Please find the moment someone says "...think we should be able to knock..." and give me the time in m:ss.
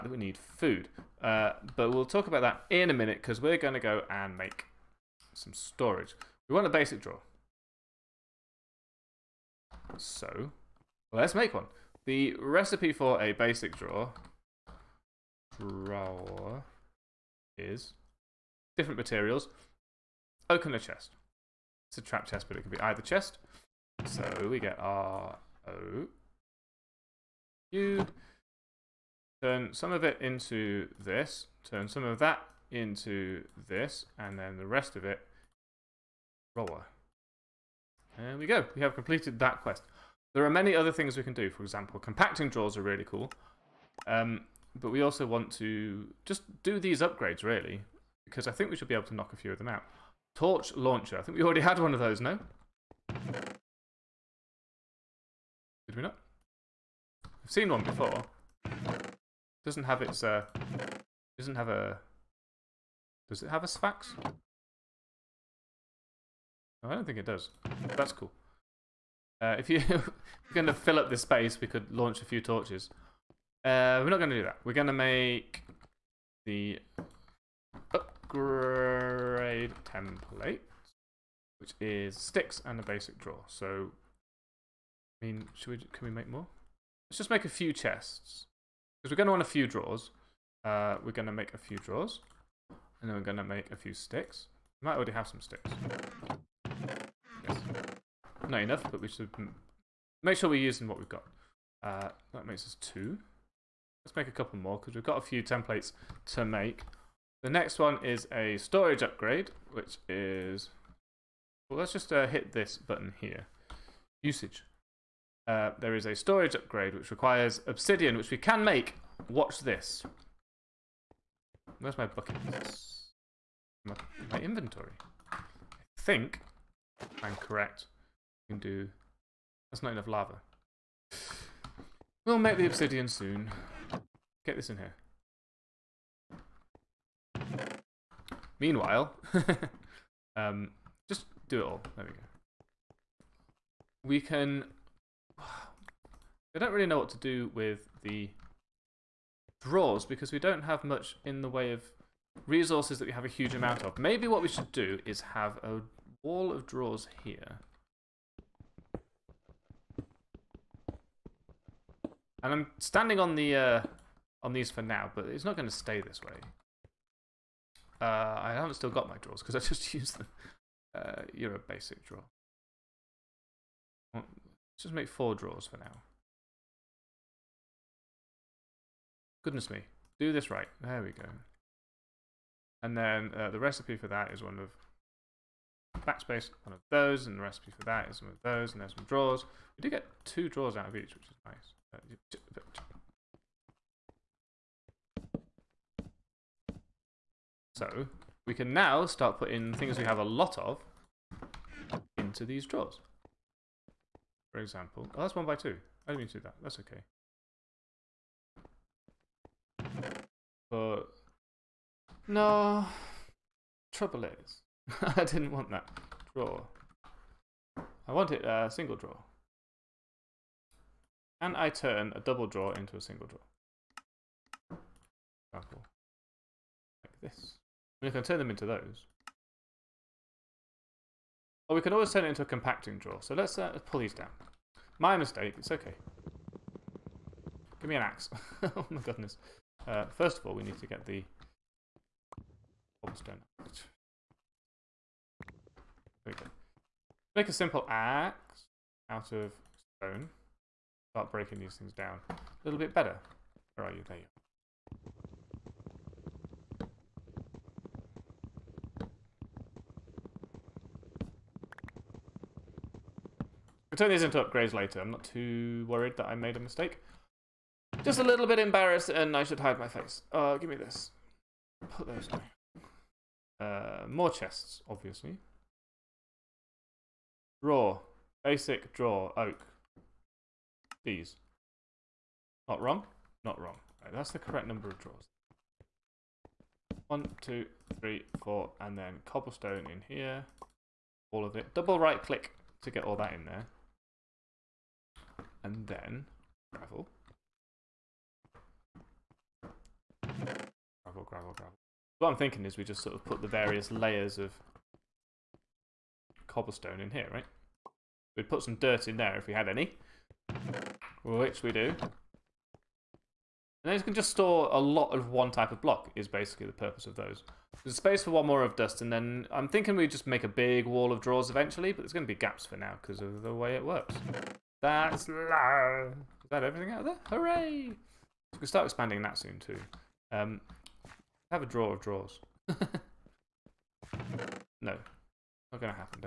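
0:48.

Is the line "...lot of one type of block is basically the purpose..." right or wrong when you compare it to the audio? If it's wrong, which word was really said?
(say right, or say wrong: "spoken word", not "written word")
right.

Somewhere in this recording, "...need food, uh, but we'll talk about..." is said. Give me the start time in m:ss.
0:00.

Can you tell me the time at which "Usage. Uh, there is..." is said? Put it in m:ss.
1:54.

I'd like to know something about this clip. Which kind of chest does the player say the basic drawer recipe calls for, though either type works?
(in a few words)
Trap chest.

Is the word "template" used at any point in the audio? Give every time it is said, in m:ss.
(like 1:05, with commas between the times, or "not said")
1:19, 1:45.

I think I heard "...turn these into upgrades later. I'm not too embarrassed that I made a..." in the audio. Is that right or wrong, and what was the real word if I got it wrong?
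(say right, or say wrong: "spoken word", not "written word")
wrong: "worried", not "embarrassed".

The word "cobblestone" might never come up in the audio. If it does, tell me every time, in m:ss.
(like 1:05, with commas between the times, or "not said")
4:03, 4:49, 5:06.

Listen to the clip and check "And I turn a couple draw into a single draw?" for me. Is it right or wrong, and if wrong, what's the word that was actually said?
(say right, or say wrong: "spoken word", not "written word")
wrong: "double", not "couple".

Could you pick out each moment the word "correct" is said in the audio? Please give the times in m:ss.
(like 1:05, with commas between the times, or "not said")
2:07, 4:44.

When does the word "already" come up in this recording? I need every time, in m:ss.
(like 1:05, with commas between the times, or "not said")
0:51, 1:34.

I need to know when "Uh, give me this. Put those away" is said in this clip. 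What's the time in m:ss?
4:30.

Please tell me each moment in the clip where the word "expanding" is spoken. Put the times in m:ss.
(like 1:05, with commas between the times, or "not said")
5:28.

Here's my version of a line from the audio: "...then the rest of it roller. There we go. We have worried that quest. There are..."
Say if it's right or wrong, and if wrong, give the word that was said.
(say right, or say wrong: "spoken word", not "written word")
wrong: "completed", not "worried".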